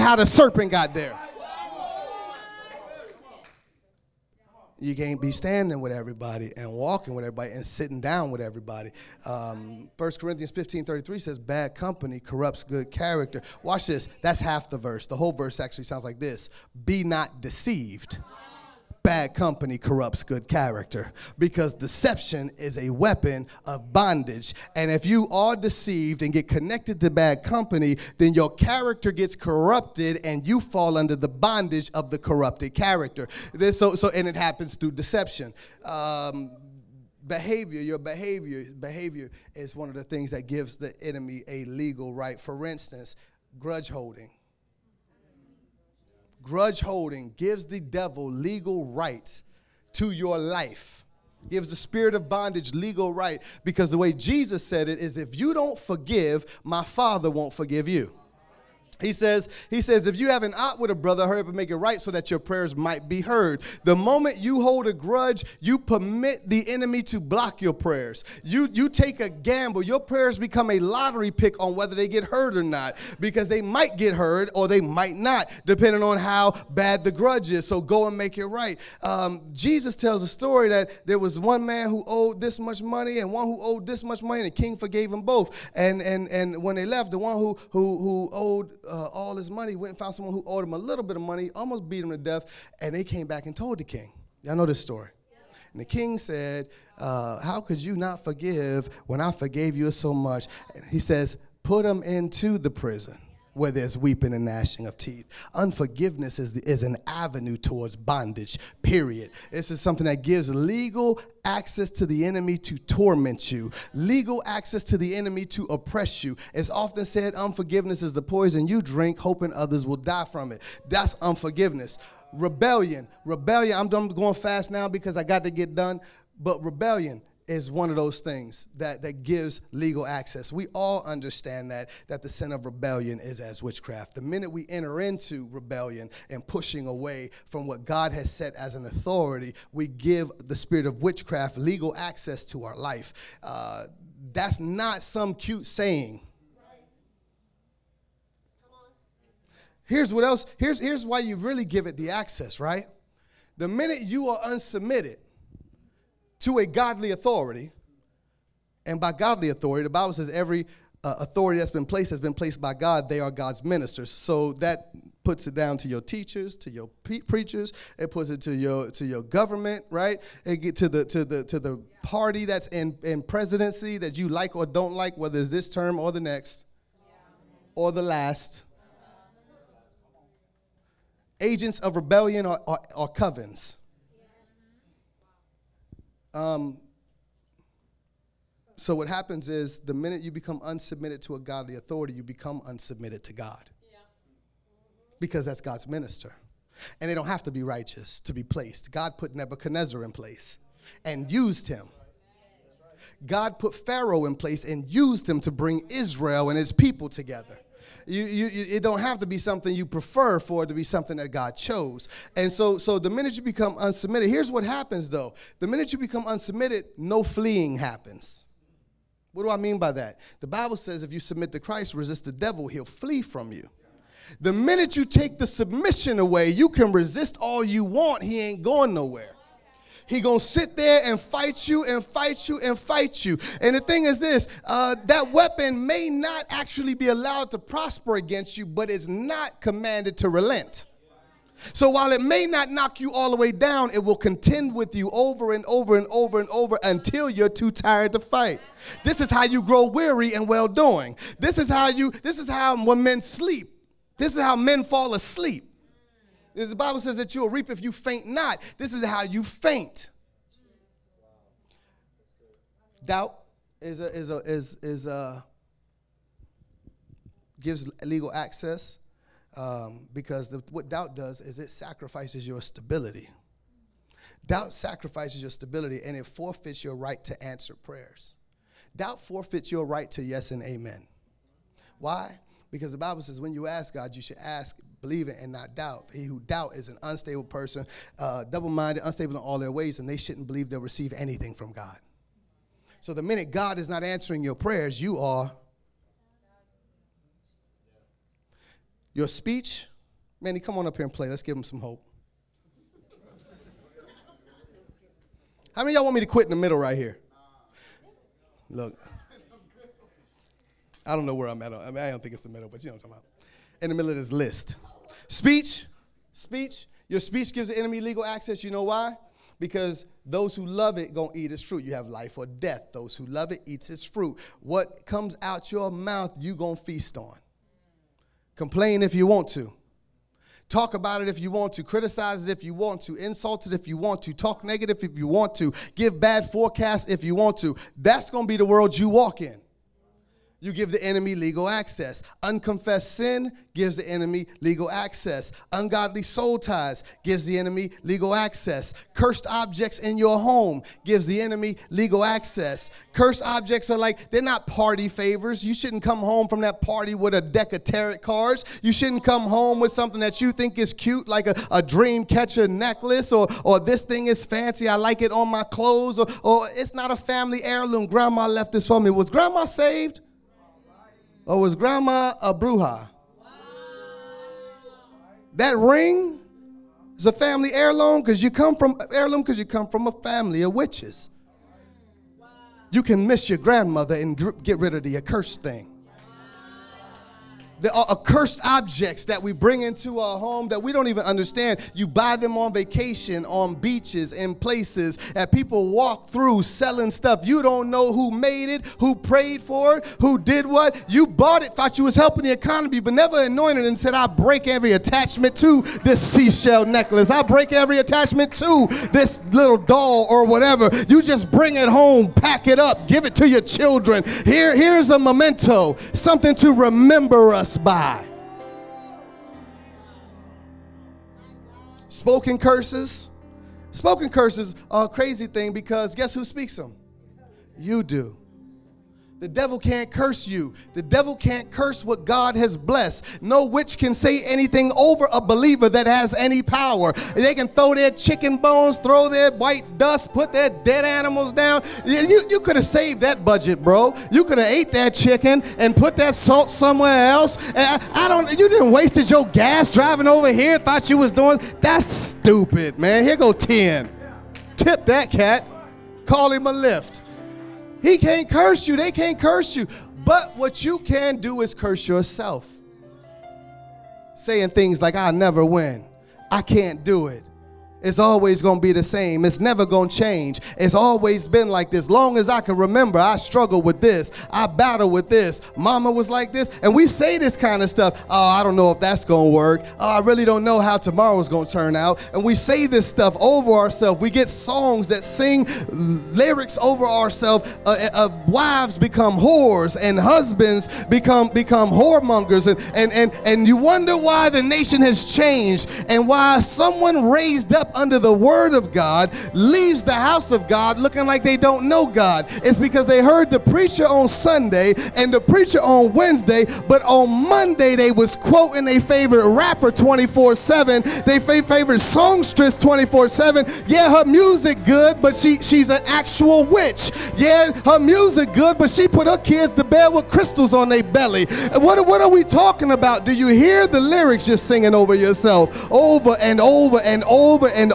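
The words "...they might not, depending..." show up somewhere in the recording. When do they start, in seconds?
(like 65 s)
74 s.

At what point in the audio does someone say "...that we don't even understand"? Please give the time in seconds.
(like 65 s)
390 s.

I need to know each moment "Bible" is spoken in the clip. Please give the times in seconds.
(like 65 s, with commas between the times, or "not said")
159 s, 220 s, 256 s, 282 s.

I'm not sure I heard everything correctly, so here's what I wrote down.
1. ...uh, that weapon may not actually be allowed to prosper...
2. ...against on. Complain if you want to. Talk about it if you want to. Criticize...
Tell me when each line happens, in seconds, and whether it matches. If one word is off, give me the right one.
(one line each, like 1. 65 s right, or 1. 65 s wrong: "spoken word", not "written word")
1. 234 s right
2. 326 s wrong: "feast", not "against".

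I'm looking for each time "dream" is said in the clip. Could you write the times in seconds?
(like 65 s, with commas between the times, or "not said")
361 s.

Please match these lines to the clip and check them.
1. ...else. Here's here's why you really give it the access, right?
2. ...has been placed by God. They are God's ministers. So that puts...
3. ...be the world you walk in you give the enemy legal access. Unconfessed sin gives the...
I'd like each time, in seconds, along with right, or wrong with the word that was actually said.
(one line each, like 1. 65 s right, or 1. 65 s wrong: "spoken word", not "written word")
1. 150 s right
2. 162 s right
3. 338 s right.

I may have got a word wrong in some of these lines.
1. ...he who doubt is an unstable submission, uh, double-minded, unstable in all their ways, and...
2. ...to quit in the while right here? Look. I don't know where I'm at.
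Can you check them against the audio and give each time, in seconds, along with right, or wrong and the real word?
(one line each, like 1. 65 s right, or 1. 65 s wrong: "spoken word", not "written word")
1. 286 s wrong: "person", not "submission"
2. 306 s wrong: "middle", not "while".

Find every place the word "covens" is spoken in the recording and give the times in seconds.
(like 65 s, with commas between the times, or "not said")
183 s.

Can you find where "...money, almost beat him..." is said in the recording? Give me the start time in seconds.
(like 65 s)
91 s.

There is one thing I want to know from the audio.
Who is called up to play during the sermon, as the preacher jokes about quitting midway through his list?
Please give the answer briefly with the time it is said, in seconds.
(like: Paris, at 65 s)
Manny, at 300 s.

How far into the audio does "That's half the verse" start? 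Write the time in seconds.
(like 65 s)
14 s.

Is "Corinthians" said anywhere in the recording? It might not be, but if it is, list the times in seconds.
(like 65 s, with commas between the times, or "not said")
10 s.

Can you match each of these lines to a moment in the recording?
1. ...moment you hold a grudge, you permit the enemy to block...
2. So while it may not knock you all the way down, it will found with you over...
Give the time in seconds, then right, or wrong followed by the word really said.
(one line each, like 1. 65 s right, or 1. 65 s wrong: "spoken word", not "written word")
1. 63 s right
2. 241 s wrong: "contend", not "found".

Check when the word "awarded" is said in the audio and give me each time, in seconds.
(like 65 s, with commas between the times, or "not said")
not said.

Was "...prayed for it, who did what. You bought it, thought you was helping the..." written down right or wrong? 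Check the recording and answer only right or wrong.
right.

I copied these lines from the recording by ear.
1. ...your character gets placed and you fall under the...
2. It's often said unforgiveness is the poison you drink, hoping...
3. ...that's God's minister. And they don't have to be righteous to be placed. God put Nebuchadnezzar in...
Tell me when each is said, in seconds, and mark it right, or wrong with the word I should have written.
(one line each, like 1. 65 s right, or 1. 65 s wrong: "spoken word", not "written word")
1. 28 s wrong: "corrupted", not "placed"
2. 116 s right
3. 195 s right.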